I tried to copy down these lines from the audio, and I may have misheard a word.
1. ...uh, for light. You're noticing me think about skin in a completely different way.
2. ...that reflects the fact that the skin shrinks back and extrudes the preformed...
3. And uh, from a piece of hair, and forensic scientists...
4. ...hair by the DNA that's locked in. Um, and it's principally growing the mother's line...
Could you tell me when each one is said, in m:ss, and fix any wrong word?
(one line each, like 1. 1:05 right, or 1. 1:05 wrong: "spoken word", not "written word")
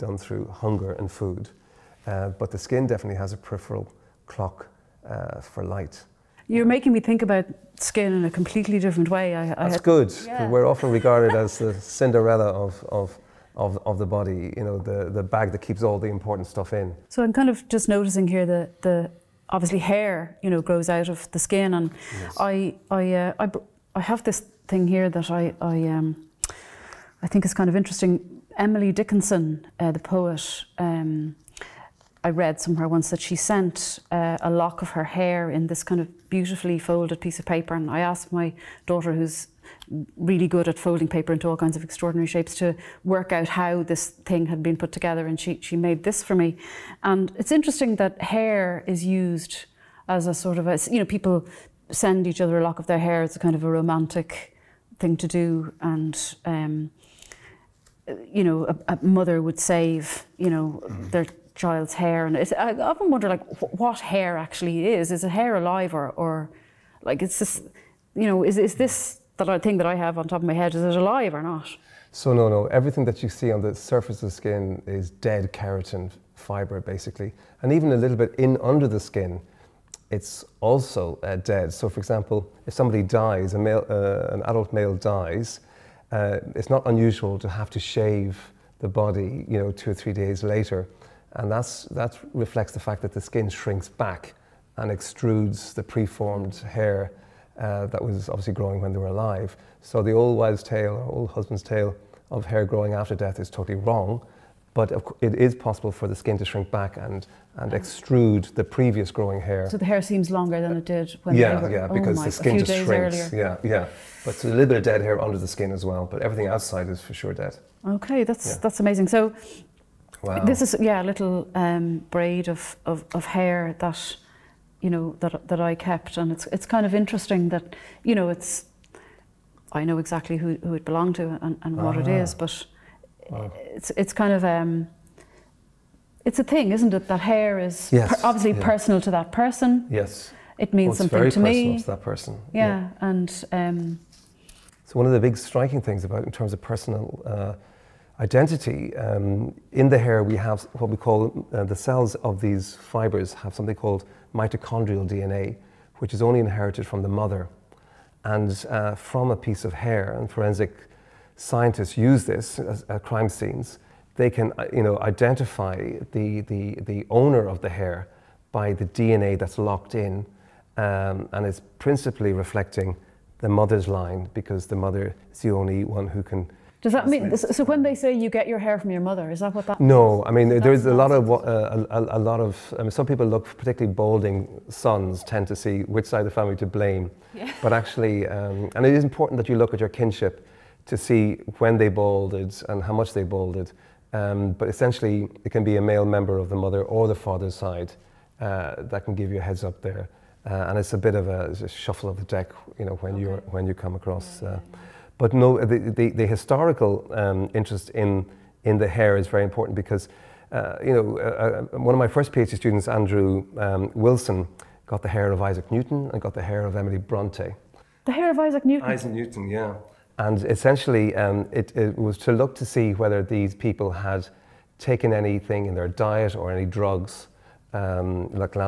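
1. 0:05 wrong: "making", not "noticing"
2. 1:31 right
3. 2:38 right
4. 2:47 wrong: "reflecting", not "growing".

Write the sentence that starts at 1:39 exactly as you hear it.
So the old wives' tale, or old husband's tale of hair growing after death is totally wrong.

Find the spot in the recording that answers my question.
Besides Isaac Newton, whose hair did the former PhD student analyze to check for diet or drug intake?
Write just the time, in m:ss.
3:36.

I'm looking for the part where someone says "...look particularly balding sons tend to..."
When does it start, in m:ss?
3:03.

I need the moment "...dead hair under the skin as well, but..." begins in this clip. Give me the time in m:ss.
1:54.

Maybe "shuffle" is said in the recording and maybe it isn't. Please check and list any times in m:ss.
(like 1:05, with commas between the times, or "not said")
3:21.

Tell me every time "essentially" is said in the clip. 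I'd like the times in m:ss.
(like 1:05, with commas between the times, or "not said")
3:14, 3:40.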